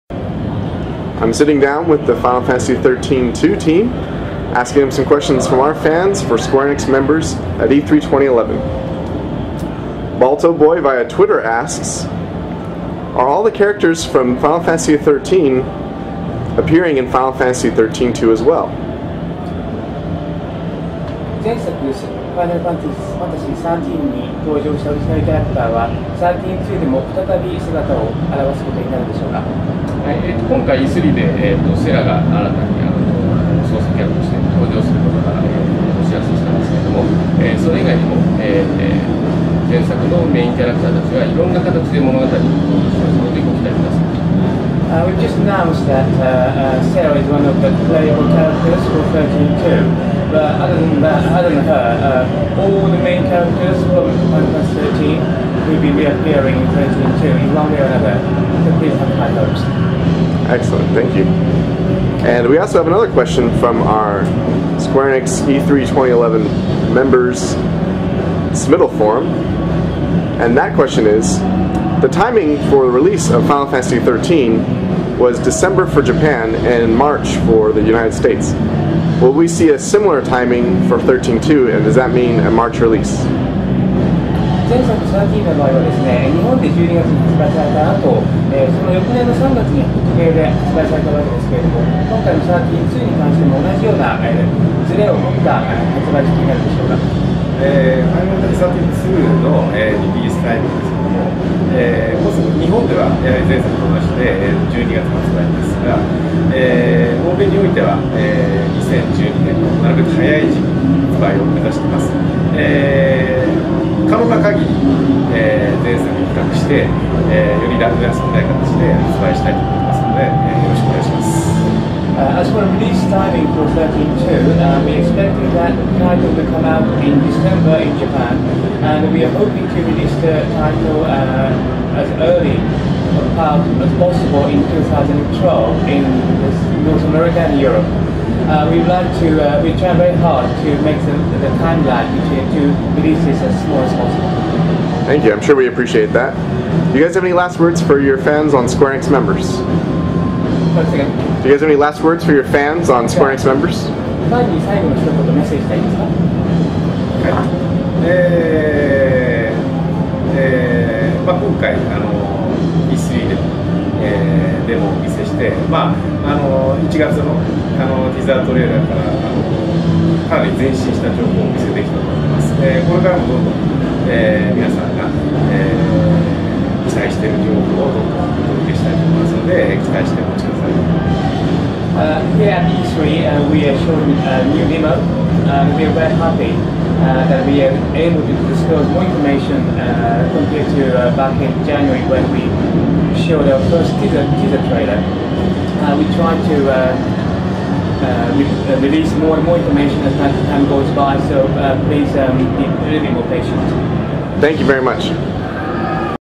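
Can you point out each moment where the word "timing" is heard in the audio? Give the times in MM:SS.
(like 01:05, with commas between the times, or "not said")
01:12, 01:20, 02:03.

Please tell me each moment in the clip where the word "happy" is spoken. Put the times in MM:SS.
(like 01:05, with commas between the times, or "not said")
03:06.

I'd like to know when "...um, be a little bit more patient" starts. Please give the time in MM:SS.
03:22.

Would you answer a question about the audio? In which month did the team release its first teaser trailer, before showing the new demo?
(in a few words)
January.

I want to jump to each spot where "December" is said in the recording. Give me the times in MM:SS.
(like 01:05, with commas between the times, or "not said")
01:15, 02:07.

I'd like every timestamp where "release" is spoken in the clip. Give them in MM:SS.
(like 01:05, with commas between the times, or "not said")
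01:12, 01:22, 02:02, 02:09, 02:22, 03:18.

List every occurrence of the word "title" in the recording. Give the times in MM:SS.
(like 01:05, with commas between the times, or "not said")
02:05, 02:10.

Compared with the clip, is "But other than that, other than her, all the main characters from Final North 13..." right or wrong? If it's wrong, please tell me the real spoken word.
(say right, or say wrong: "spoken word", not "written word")
wrong: "Fantasy", not "North".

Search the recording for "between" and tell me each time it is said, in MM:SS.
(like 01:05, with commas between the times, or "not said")
02:22.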